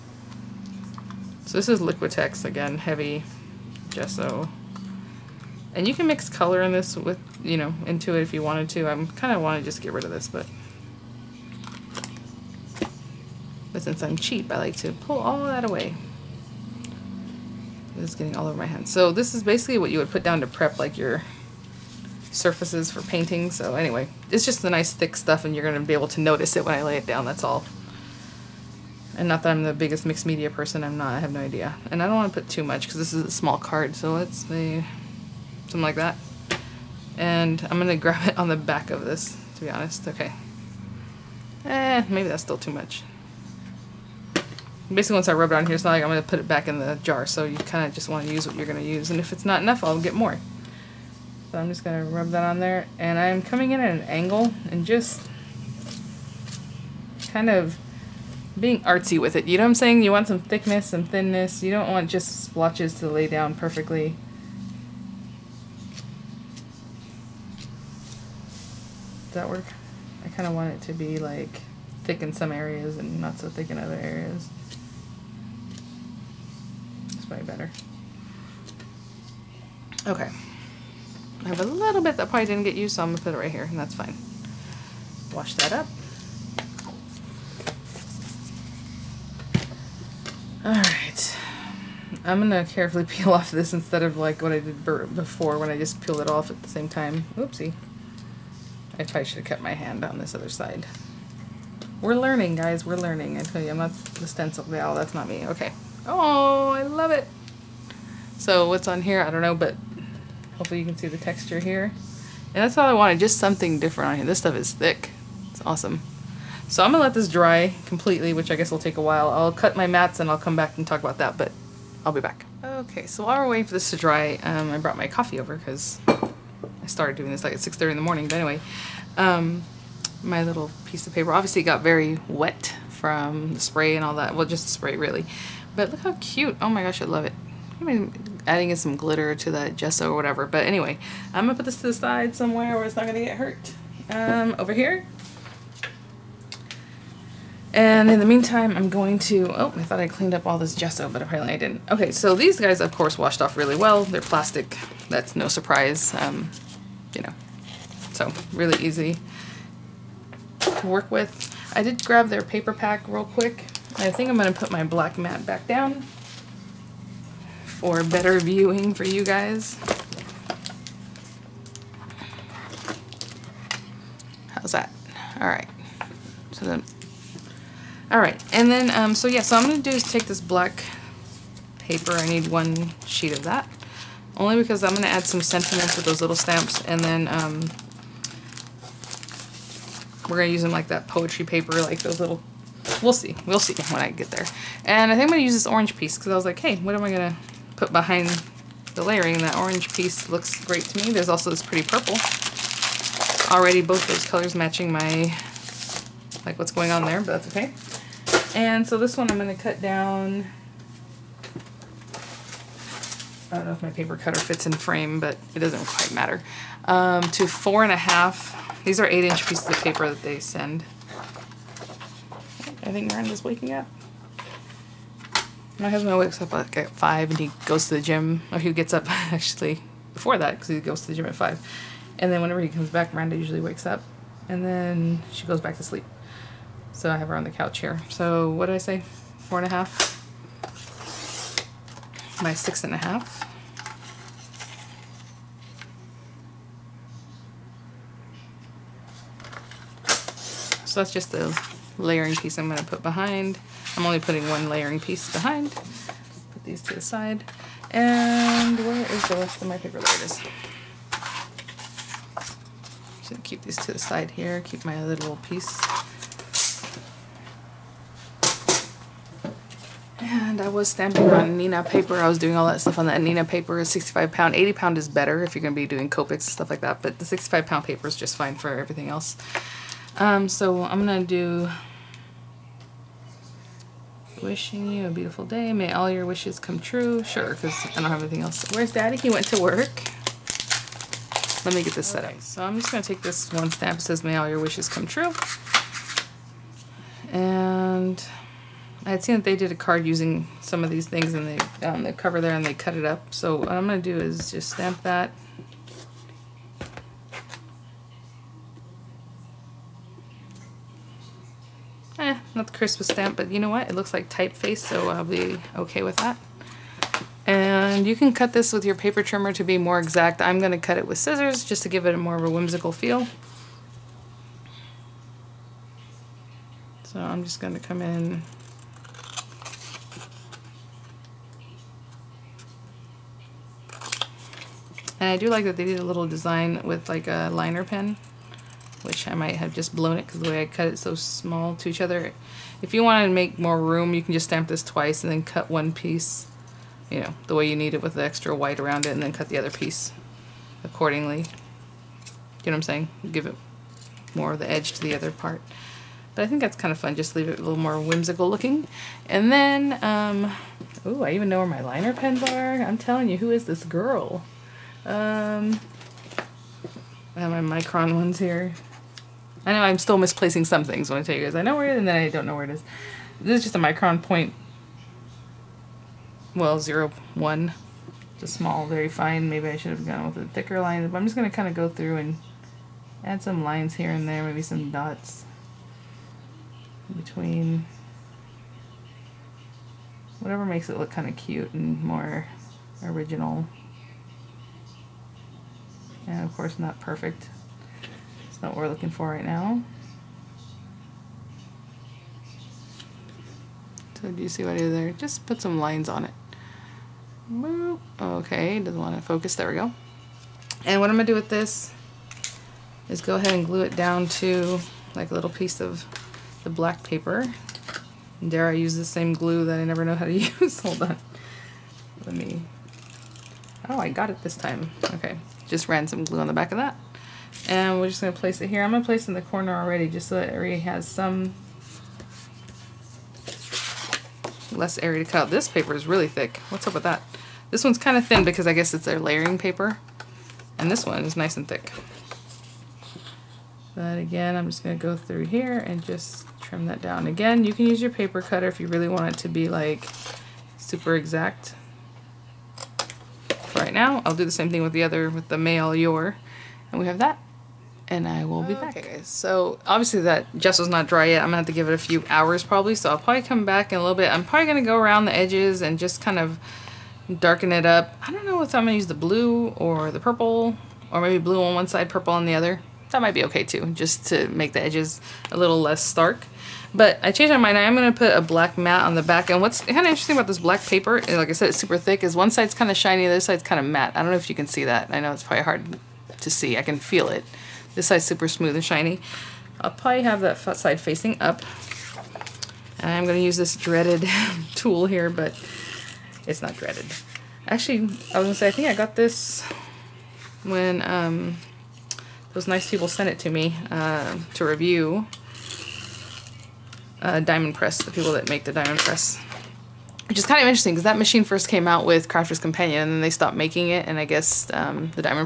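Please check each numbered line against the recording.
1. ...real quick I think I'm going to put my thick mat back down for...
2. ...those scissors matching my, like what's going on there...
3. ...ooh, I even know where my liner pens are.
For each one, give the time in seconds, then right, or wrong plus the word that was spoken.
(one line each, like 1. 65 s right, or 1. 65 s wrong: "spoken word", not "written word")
1. 163 s wrong: "black", not "thick"
2. 204 s wrong: "colors", not "scissors"
3. 361 s right.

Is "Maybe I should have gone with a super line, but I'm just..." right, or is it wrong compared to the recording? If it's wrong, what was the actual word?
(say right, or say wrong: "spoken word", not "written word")
wrong: "thicker", not "super".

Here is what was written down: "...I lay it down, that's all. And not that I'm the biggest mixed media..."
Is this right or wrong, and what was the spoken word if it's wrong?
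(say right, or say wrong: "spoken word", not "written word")
right.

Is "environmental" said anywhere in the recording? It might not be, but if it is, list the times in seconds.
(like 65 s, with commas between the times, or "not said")
not said.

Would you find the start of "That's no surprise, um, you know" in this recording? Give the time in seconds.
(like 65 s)
155 s.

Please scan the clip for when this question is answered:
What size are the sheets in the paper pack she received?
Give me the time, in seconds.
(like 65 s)
219 s.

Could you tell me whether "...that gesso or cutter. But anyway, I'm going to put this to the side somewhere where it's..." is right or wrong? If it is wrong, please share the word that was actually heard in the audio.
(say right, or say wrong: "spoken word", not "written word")
wrong: "whatever", not "cutter".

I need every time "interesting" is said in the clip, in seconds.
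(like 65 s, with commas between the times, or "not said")
480 s, 510 s.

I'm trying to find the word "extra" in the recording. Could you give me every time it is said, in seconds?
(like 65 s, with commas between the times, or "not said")
348 s.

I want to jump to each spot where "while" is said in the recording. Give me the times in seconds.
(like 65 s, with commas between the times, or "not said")
119 s, 123 s.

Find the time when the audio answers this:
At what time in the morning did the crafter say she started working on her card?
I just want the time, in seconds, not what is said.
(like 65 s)
127 s.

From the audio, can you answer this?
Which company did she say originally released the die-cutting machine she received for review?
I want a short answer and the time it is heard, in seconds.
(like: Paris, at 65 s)
Crafter's Companion, at 512 s.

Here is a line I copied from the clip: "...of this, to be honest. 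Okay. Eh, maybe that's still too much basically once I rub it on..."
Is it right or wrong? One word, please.
right.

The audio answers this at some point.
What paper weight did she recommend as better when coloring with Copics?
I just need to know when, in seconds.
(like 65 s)
274 s.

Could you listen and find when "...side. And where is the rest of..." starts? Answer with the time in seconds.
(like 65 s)
257 s.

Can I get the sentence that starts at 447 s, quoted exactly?
Again, you can use your paper cutter if you really want it to be like super exact.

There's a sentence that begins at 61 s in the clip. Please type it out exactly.
You don't want just splotches to lay down perfectly.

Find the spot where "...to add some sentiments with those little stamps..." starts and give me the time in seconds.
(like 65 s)
185 s.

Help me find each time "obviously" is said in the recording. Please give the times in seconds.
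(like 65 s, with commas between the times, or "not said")
131 s, 459 s.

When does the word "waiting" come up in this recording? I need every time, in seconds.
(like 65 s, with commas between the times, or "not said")
123 s.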